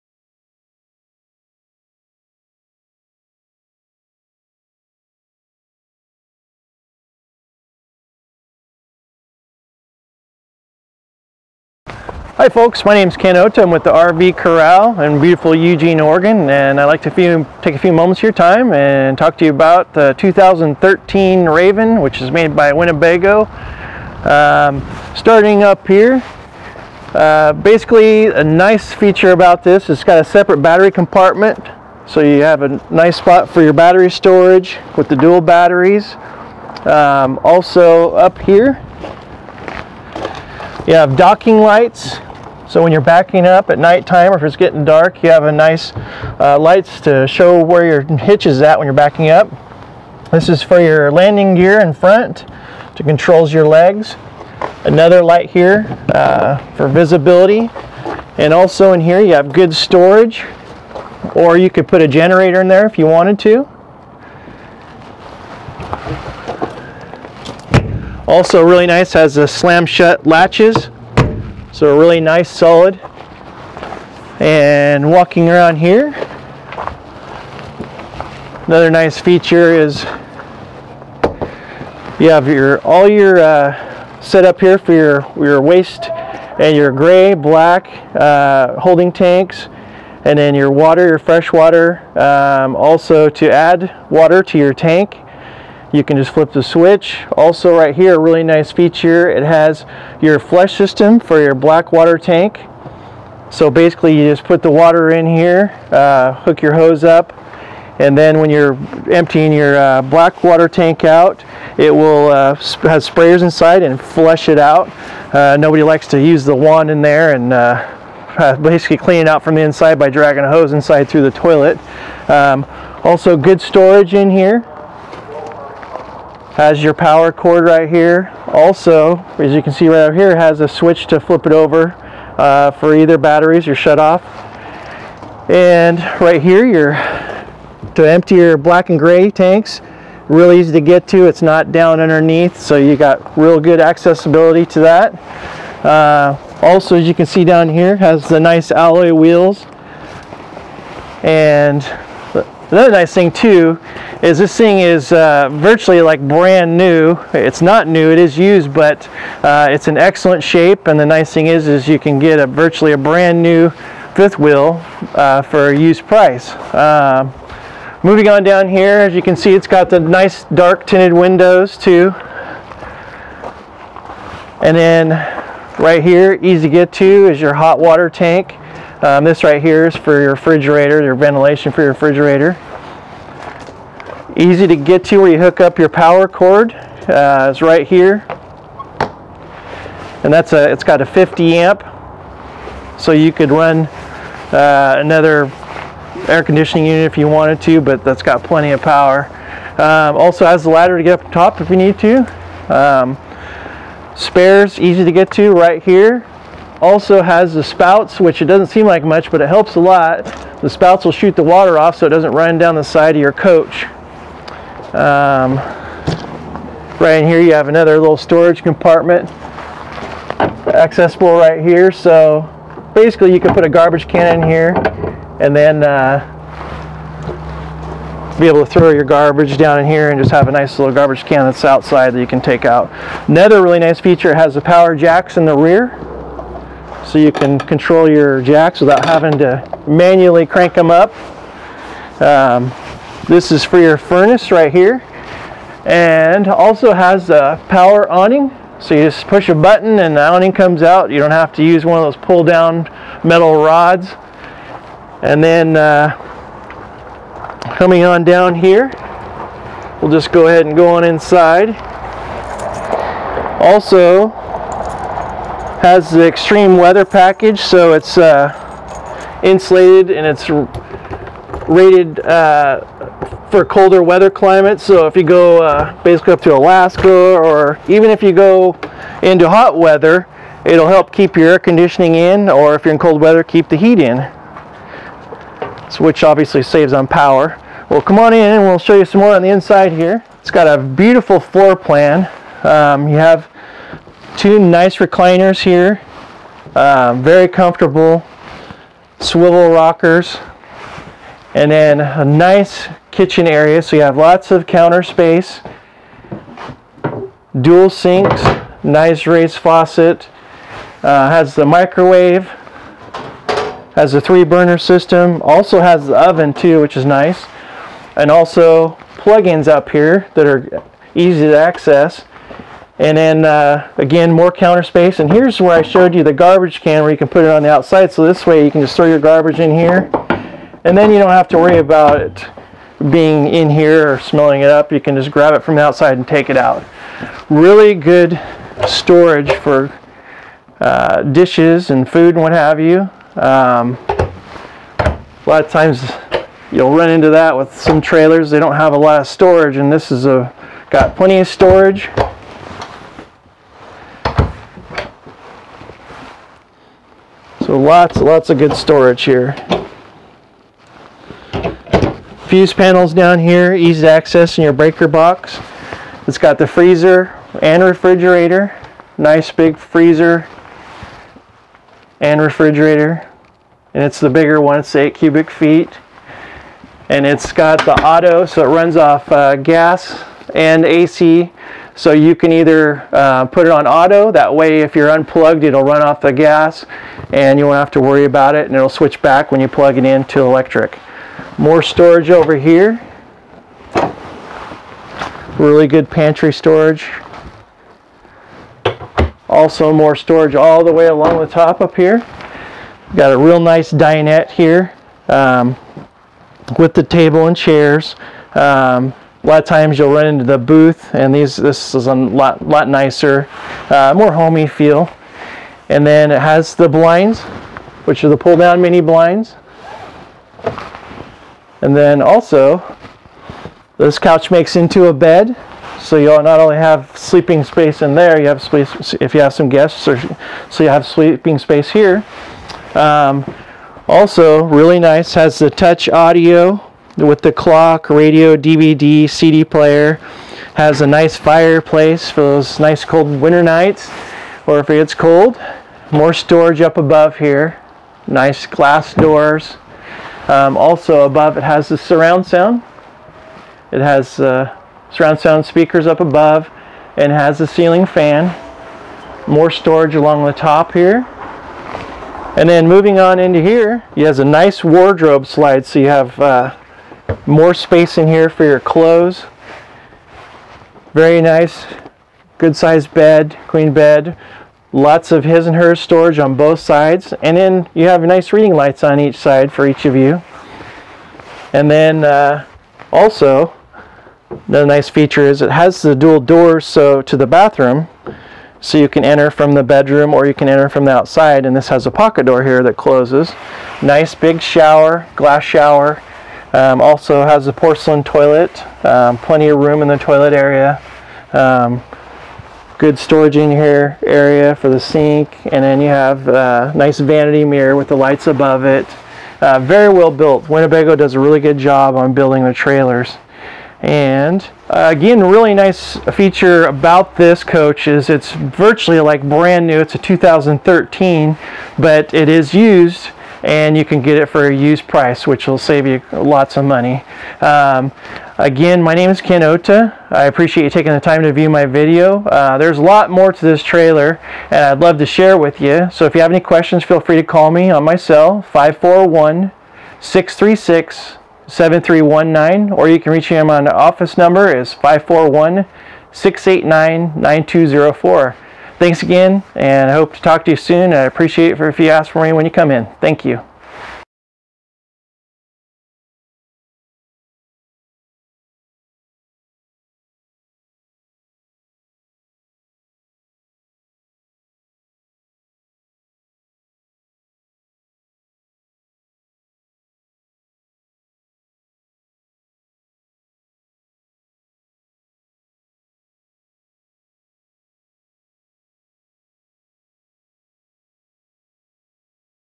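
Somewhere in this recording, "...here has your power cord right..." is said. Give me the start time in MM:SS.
02:04.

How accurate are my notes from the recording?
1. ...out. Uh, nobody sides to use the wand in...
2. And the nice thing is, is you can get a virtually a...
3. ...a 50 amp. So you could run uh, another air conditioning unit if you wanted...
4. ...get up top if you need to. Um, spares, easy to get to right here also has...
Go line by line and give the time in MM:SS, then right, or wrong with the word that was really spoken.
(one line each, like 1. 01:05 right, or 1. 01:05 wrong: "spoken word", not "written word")
1. 01:54 wrong: "likes", not "sides"
2. 02:40 right
3. 03:11 right
4. 03:21 right.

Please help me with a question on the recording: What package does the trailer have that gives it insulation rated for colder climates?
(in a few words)
extreme weather package.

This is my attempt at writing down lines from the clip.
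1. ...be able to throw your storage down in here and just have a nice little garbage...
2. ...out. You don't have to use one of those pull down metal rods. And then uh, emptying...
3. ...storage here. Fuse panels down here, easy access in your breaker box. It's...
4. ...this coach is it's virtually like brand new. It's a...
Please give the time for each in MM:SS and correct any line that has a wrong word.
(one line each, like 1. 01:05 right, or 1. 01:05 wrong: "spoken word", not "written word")
1. 03:48 wrong: "garbage", not "storage"
2. 04:10 wrong: "coming", not "emptying"
3. 05:58 right
4. 08:37 right.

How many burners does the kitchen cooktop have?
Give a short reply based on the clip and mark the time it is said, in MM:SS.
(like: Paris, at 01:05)
3, at 05:14.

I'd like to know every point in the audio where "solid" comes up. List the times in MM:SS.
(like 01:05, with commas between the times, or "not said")
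01:12.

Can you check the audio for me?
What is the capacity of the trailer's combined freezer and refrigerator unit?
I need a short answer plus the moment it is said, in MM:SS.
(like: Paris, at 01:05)
8 cubic feet, at 06:14.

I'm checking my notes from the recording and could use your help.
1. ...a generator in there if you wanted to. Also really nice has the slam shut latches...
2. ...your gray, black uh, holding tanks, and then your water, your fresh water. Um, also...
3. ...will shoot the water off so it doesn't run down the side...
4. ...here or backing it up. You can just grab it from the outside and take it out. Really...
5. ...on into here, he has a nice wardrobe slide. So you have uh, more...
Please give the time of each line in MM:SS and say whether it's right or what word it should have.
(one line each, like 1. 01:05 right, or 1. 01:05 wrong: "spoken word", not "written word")
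1. 01:02 right
2. 01:26 right
3. 03:31 right
4. 05:33 wrong: "smelling", not "backing"
5. 07:43 right.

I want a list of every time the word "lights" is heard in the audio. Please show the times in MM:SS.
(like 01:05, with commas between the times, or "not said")
00:41, 00:46, 00:55, 07:58, 08:28.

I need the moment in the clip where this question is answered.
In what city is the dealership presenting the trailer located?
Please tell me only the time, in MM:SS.
00:15.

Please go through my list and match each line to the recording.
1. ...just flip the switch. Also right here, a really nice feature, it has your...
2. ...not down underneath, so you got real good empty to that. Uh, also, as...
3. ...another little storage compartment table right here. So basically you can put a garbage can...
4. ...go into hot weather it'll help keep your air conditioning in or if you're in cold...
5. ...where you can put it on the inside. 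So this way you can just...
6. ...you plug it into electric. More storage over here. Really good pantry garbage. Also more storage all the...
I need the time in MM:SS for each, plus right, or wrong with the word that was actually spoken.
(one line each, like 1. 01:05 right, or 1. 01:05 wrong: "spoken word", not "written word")
1. 01:36 right
2. 02:21 wrong: "accessibility", not "empty"
3. 03:37 wrong: "accessible", not "table"
4. 04:38 right
5. 05:27 wrong: "outside", not "inside"
6. 06:29 wrong: "storage", not "garbage".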